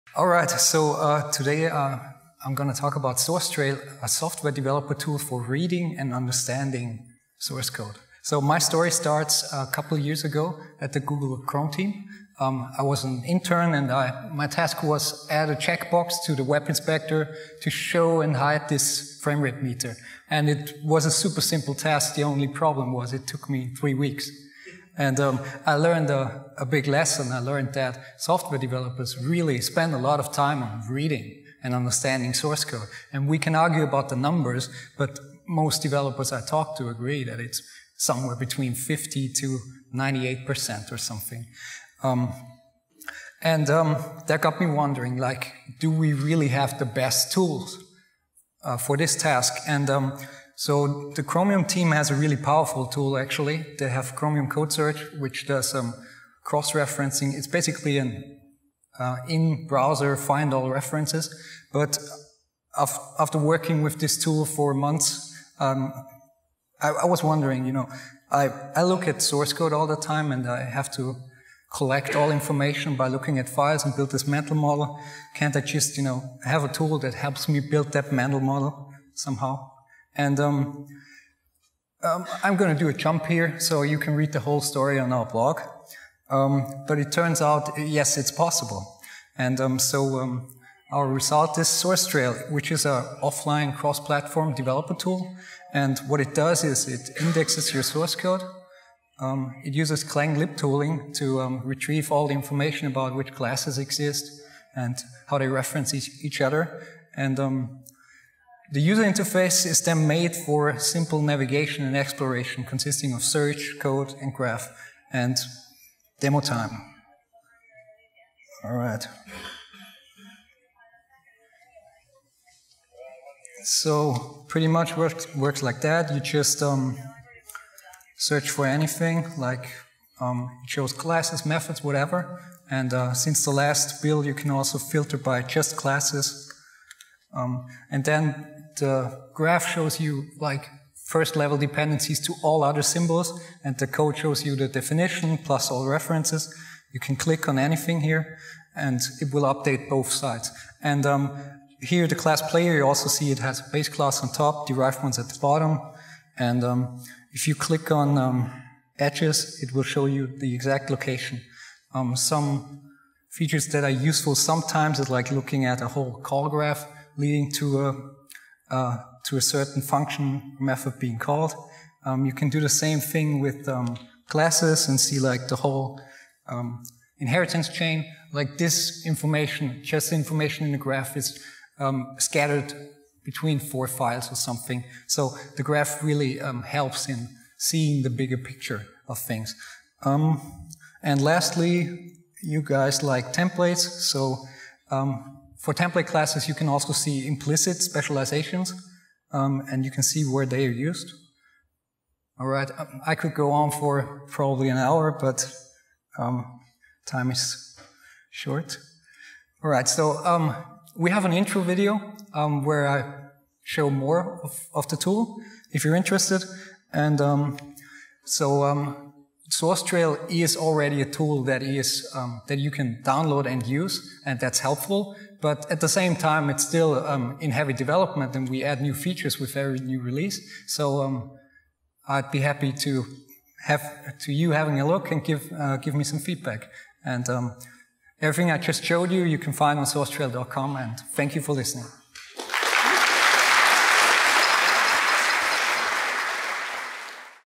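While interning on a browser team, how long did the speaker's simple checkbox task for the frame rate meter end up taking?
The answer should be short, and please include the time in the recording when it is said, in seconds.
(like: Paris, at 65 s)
3 weeks, at 23 s.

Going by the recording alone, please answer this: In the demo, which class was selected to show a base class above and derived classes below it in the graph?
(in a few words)
Player.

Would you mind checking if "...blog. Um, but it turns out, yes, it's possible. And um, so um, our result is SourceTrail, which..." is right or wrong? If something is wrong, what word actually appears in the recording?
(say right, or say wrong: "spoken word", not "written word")
right.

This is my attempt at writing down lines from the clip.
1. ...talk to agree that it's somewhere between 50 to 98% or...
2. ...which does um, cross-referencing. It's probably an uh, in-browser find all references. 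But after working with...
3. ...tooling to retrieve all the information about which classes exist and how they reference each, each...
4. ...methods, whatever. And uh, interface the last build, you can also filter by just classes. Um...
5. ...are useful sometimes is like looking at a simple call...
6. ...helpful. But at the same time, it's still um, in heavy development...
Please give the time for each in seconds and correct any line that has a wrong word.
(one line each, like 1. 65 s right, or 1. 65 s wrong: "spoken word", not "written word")
1. 36 s right
2. 55 s wrong: "basically", not "probably"
3. 100 s right
4. 131 s wrong: "since", not "interface"
5. 163 s wrong: "whole", not "simple"
6. 224 s right.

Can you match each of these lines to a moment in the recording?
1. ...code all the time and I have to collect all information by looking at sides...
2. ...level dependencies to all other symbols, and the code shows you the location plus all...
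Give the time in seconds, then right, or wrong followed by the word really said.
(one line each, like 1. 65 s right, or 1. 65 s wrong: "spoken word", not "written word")
1. 69 s wrong: "files", not "sides"
2. 141 s wrong: "definition", not "location".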